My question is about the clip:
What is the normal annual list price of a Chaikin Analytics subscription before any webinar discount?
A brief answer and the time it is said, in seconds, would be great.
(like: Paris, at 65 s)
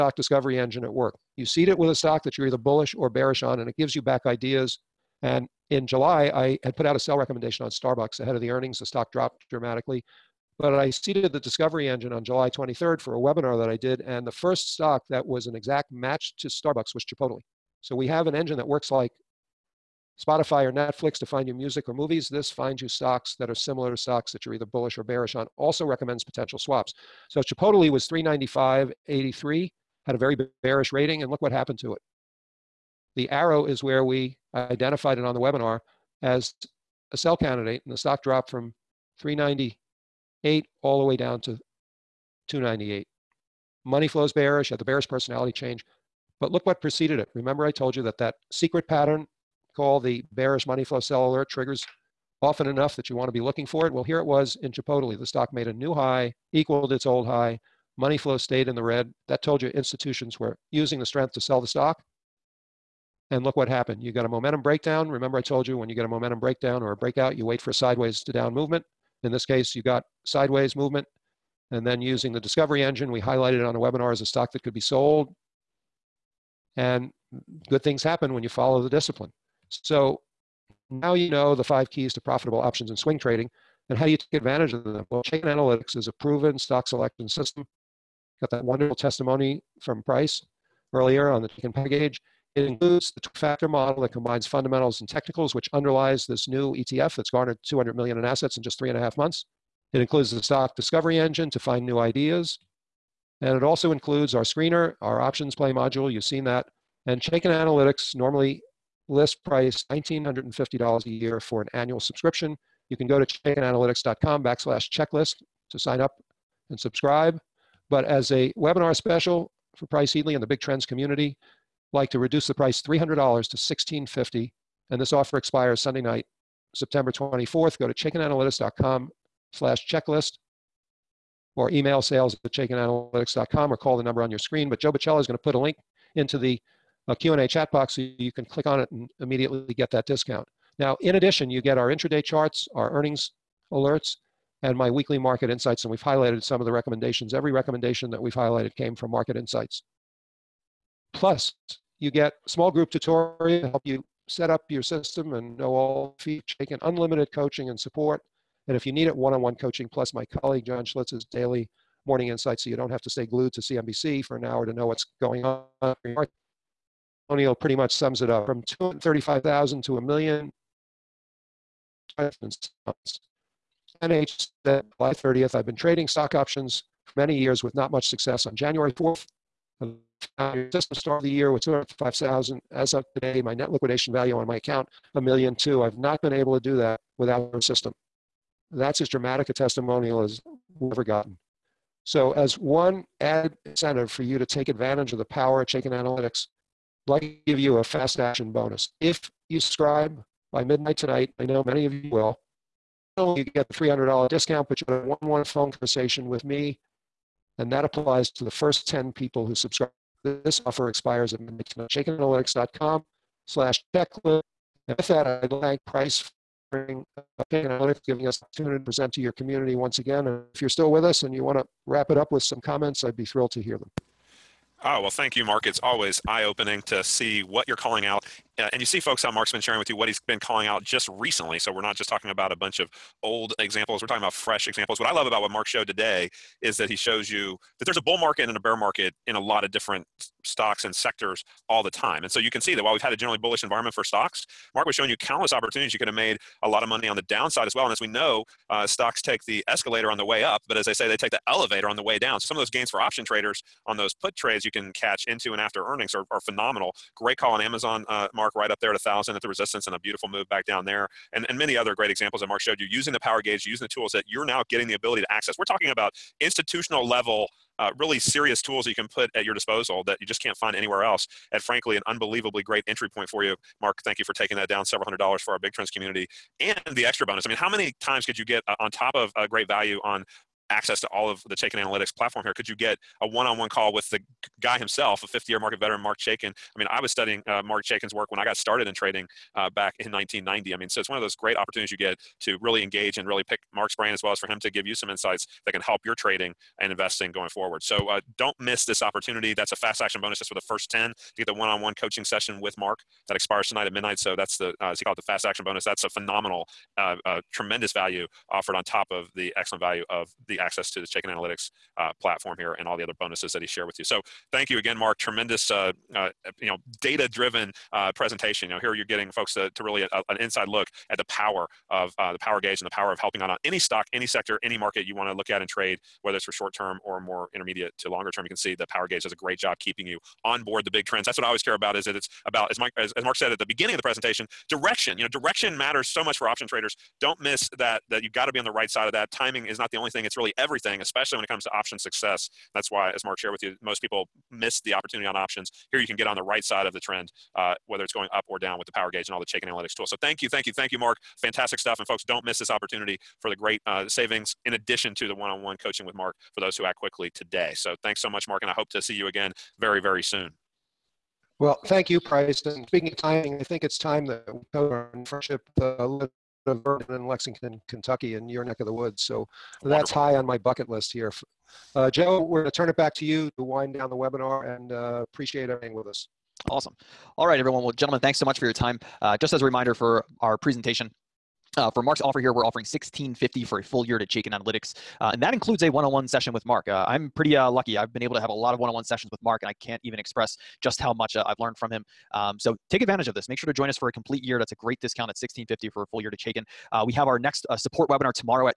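$1,950, at 109 s.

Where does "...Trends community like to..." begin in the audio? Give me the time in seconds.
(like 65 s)
120 s.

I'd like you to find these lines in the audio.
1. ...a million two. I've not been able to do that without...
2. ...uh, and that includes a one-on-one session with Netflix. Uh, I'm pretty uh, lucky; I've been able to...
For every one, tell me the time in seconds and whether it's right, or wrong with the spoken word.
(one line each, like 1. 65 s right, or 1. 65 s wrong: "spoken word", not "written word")
1. 185 s right
2. 385 s wrong: "Mark", not "Netflix".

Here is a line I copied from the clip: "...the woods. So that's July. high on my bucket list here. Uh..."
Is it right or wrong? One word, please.
wrong.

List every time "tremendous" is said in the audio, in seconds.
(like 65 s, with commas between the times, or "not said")
307 s, 315 s.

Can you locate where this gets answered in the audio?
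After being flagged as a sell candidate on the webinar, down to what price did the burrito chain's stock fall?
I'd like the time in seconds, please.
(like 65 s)
42 s.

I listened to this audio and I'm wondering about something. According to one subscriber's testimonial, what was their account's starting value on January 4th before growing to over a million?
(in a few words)
205,000.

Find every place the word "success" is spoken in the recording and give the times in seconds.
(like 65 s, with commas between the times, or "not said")
178 s, 341 s.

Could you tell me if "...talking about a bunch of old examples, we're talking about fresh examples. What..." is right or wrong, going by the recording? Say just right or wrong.
right.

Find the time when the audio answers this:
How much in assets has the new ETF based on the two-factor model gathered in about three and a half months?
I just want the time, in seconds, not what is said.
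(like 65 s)
97 s.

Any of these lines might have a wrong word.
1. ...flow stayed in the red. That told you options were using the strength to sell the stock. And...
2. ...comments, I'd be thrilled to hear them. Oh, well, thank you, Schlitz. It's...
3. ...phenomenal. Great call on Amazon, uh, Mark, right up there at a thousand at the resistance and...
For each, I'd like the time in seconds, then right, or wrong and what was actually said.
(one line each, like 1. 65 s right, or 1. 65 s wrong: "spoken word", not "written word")
1. 58 s wrong: "institutions", not "options"
2. 222 s wrong: "Mark", not "Schlitz"
3. 256 s right.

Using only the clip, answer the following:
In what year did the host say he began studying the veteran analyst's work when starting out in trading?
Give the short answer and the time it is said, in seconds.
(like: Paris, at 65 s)
1990, at 290 s.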